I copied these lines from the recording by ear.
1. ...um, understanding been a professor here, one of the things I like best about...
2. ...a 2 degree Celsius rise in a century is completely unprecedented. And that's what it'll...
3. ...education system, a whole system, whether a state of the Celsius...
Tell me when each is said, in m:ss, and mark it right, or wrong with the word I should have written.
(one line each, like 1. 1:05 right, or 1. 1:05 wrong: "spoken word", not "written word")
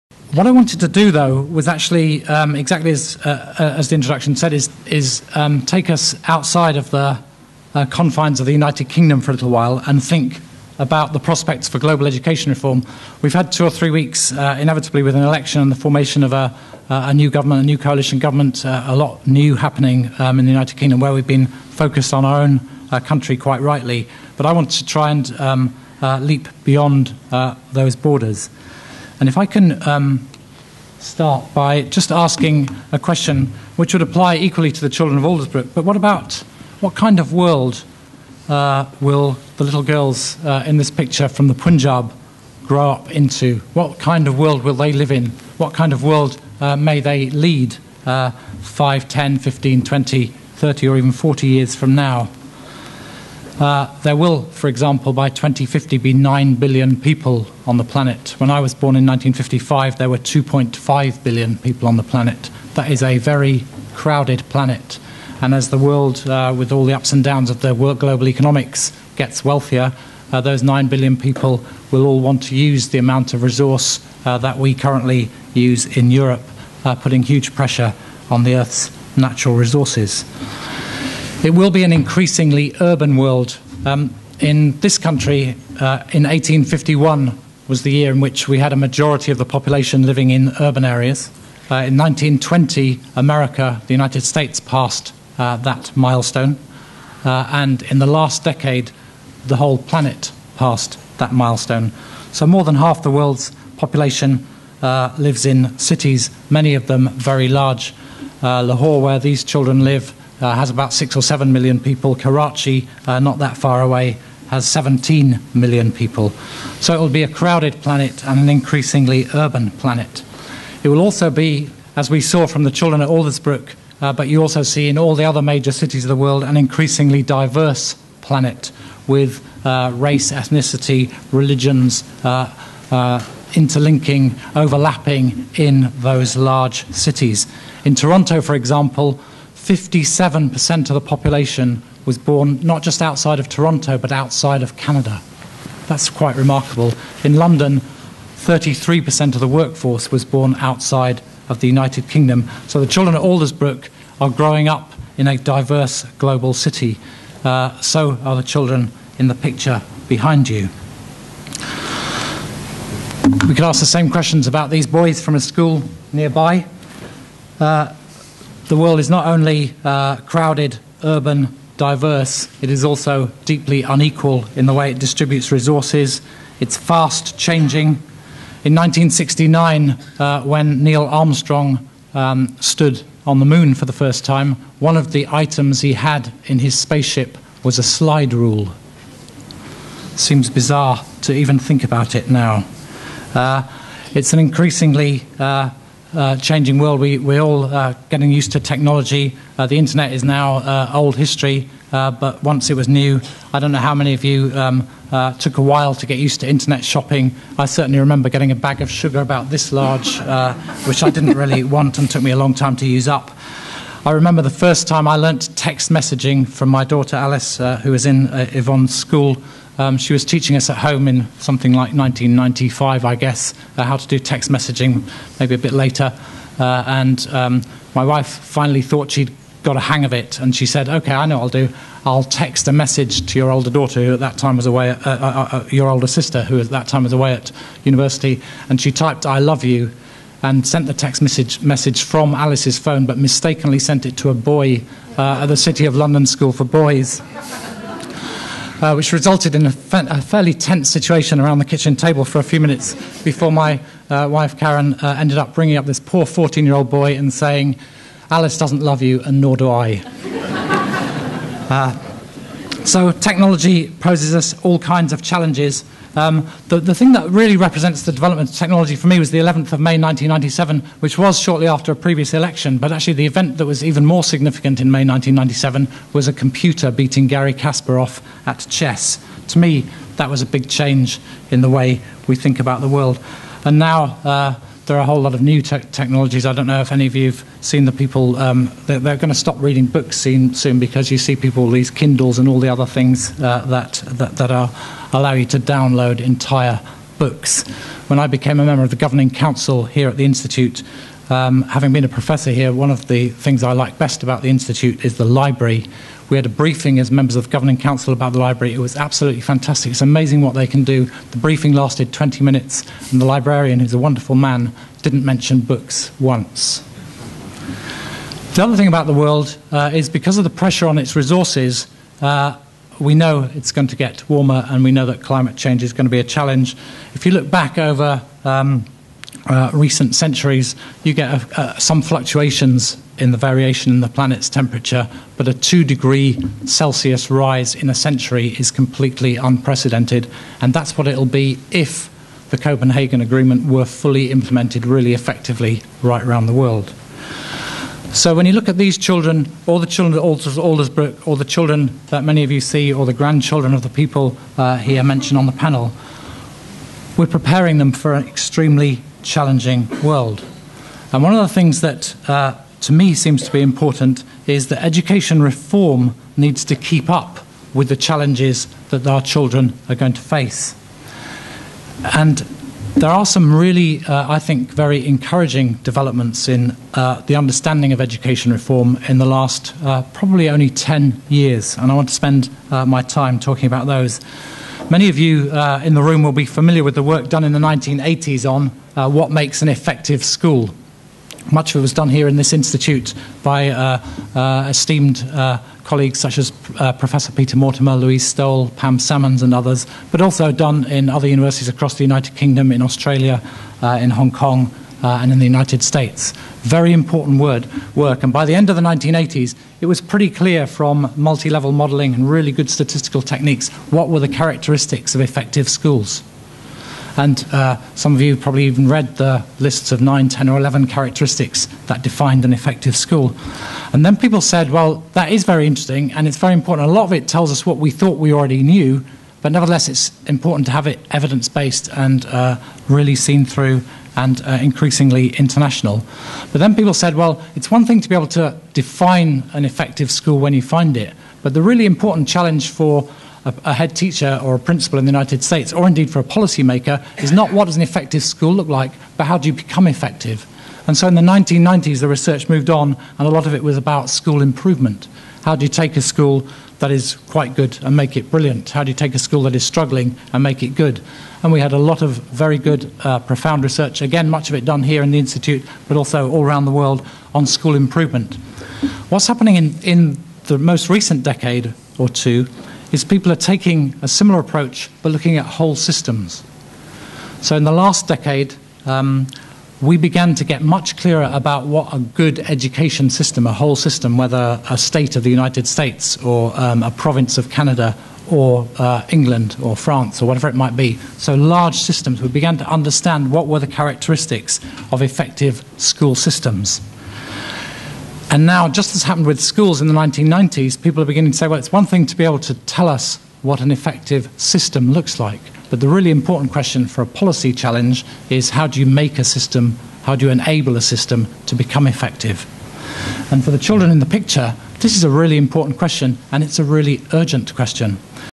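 1. 5:01 wrong: "having", not "understanding"
2. 5:35 right
3. 8:02 wrong: "United", not "Celsius".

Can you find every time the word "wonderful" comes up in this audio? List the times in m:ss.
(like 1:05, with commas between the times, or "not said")
5:13.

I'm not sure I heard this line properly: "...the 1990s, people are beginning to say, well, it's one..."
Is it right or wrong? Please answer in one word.
right.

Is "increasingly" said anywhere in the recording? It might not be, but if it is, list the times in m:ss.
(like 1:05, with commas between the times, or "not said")
1:21, 1:58, 2:06, 3:14, 7:14.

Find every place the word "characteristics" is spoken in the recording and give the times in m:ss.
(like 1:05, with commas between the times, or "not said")
6:54, 7:00, 8:13.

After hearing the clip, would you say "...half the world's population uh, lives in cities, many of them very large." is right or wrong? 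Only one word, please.
right.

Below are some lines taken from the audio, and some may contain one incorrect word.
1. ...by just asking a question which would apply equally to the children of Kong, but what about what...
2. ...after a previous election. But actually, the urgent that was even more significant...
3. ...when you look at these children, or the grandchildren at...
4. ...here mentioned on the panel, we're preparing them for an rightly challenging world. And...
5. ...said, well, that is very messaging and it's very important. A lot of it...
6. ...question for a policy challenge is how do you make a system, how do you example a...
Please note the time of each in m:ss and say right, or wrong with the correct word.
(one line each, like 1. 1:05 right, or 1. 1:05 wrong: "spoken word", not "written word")
1. 0:31 wrong: "Aldersbrook", not "Kong"
2. 4:31 wrong: "event", not "urgent"
3. 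5:48 wrong: "children", not "grandchildren"
4. 5:54 wrong: "extremely", not "rightly"
5. 7:04 wrong: "interesting", not "messaging"
6. 8:26 wrong: "enable", not "example".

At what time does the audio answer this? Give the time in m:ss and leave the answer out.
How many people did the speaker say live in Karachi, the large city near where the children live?
1:54.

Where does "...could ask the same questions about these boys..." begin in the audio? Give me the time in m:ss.
2:43.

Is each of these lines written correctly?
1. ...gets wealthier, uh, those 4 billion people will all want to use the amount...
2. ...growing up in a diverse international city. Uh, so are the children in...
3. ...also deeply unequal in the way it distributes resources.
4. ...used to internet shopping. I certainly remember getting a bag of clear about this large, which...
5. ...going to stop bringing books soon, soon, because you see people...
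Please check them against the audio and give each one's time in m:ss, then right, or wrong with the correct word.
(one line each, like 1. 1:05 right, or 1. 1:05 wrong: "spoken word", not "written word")
1. 1:09 wrong: "9", not "4"
2. 2:34 wrong: "global", not "international"
3. 2:52 right
4. 3:26 wrong: "sugar", not "clear"
5. 4:49 wrong: "reading", not "bringing".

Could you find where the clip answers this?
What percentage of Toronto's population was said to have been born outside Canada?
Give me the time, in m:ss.
2:19.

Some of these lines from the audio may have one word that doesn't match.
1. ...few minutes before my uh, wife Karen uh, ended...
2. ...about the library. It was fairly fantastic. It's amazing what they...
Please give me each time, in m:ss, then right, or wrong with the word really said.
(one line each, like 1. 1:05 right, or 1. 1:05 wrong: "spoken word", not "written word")
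1. 4:12 right
2. 5:08 wrong: "absolutely", not "fairly".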